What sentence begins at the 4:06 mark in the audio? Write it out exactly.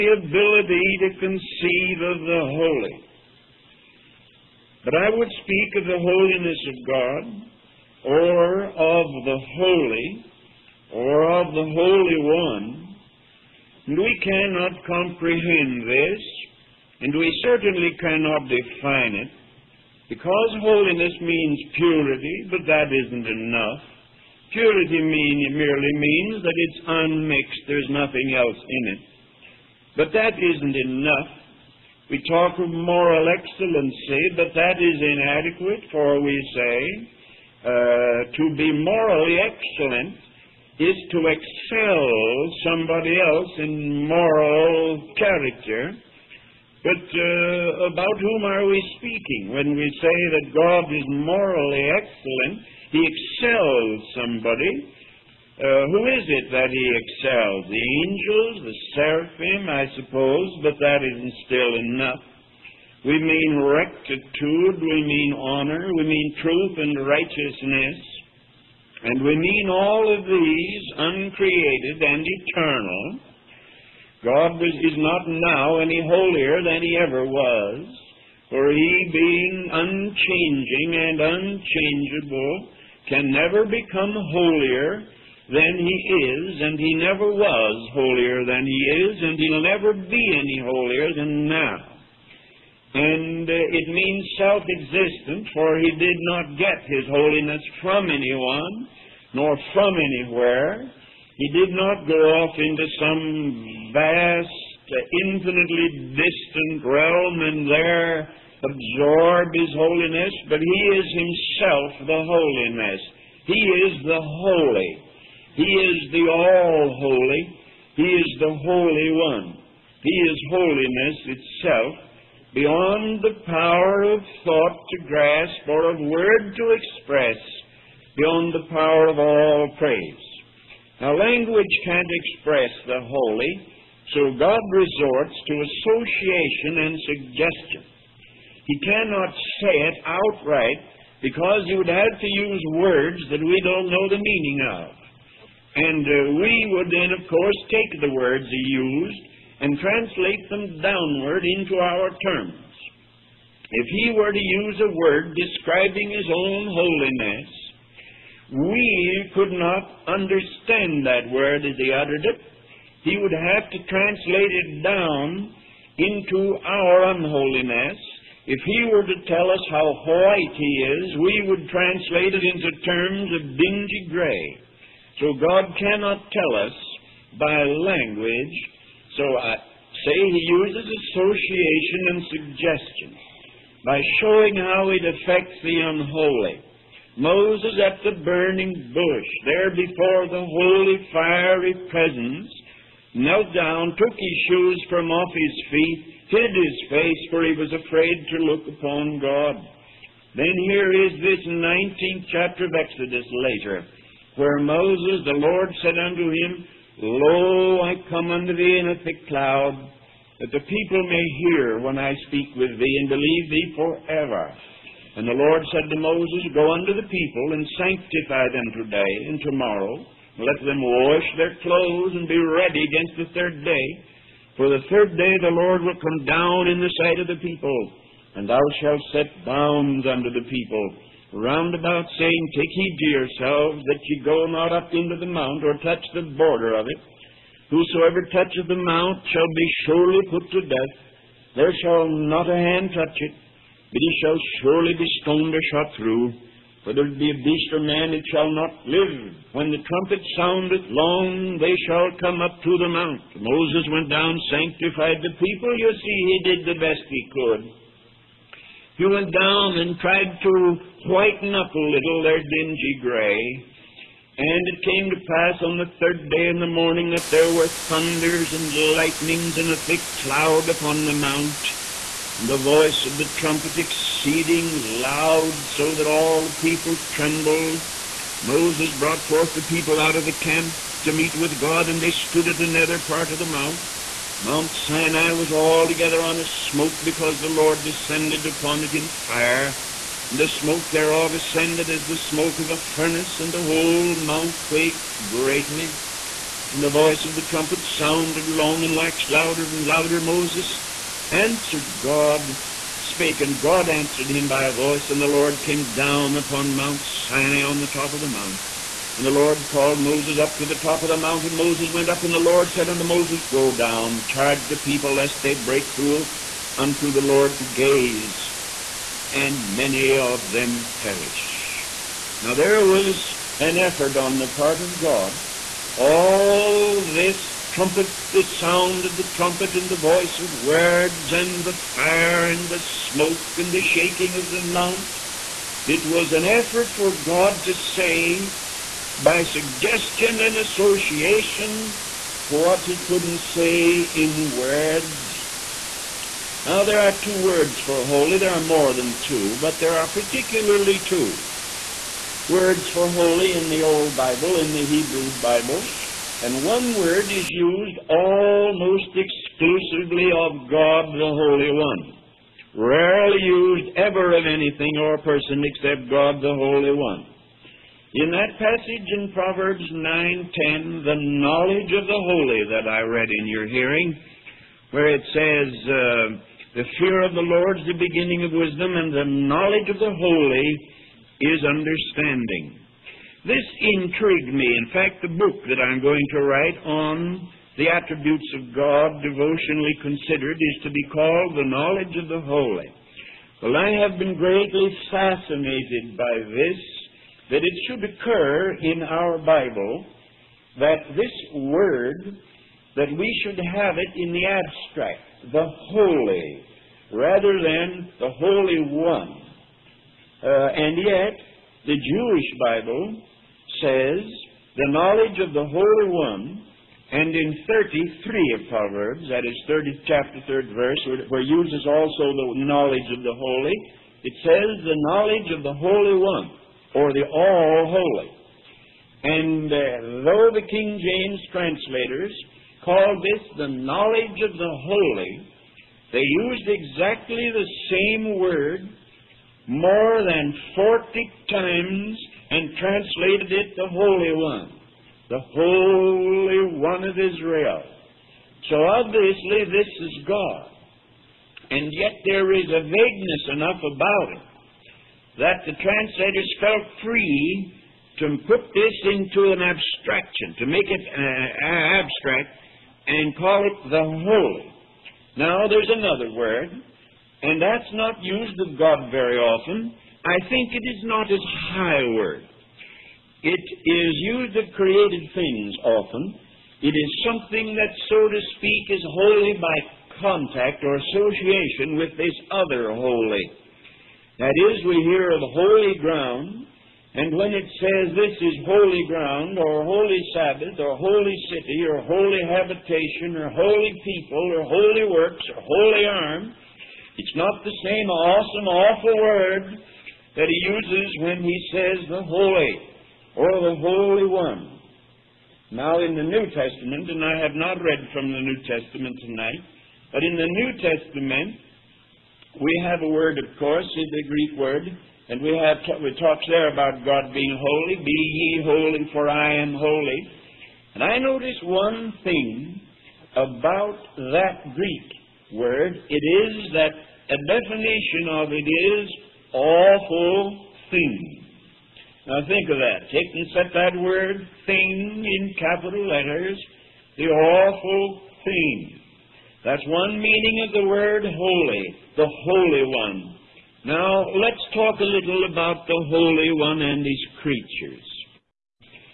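Whether it be a beast or man, it shall not live.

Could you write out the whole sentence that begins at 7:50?
I think it is not as high a word.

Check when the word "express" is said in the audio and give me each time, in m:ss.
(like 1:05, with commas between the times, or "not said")
2:06, 2:12.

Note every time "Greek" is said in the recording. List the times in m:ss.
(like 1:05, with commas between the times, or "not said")
8:34, 8:44.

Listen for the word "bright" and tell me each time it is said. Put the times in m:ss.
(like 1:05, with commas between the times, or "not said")
not said.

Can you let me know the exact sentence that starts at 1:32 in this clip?
And uh, it means self existent, for he did not get his holiness from anyone, nor from anywhere.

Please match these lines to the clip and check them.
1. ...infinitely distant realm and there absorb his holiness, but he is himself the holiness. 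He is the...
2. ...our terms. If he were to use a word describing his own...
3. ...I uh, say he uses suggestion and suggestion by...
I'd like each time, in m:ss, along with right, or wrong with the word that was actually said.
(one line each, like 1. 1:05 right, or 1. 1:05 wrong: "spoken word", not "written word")
1. 1:45 right
2. 2:31 right
3. 2:59 wrong: "association", not "suggestion".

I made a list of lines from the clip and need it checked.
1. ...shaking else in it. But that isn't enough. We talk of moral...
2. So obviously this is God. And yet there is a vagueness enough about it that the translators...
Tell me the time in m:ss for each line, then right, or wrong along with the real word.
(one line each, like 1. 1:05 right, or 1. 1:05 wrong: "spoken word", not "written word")
1. 0:27 wrong: "nothing", not "shaking"
2. 7:28 right.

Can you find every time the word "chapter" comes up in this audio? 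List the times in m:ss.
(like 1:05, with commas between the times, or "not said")
3:22, 7:00.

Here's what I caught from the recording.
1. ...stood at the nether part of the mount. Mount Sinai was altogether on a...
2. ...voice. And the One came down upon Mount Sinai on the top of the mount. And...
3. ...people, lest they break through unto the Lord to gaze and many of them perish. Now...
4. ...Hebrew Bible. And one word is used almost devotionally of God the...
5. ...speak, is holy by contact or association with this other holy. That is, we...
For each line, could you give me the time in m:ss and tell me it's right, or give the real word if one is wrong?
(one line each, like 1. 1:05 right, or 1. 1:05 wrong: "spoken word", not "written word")
1. 4:42 right
2. 5:04 wrong: "Lord", not "One"
3. 5:14 right
4. 5:54 wrong: "exclusively", not "devotionally"
5. 7:58 right.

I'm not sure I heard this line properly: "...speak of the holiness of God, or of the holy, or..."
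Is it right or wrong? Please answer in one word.
right.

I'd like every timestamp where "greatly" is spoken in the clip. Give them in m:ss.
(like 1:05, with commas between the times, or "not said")
4:55, 6:34.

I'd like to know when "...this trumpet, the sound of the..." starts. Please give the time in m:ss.
5:27.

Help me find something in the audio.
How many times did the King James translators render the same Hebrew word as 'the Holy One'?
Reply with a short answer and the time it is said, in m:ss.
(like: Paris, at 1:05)
More than 40, at 7:19.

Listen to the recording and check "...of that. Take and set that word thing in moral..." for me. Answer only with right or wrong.
wrong.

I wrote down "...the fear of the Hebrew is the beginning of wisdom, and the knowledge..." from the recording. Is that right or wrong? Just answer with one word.
wrong.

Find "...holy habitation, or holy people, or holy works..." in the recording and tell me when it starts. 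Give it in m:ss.
8:12.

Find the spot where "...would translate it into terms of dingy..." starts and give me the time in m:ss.
2:51.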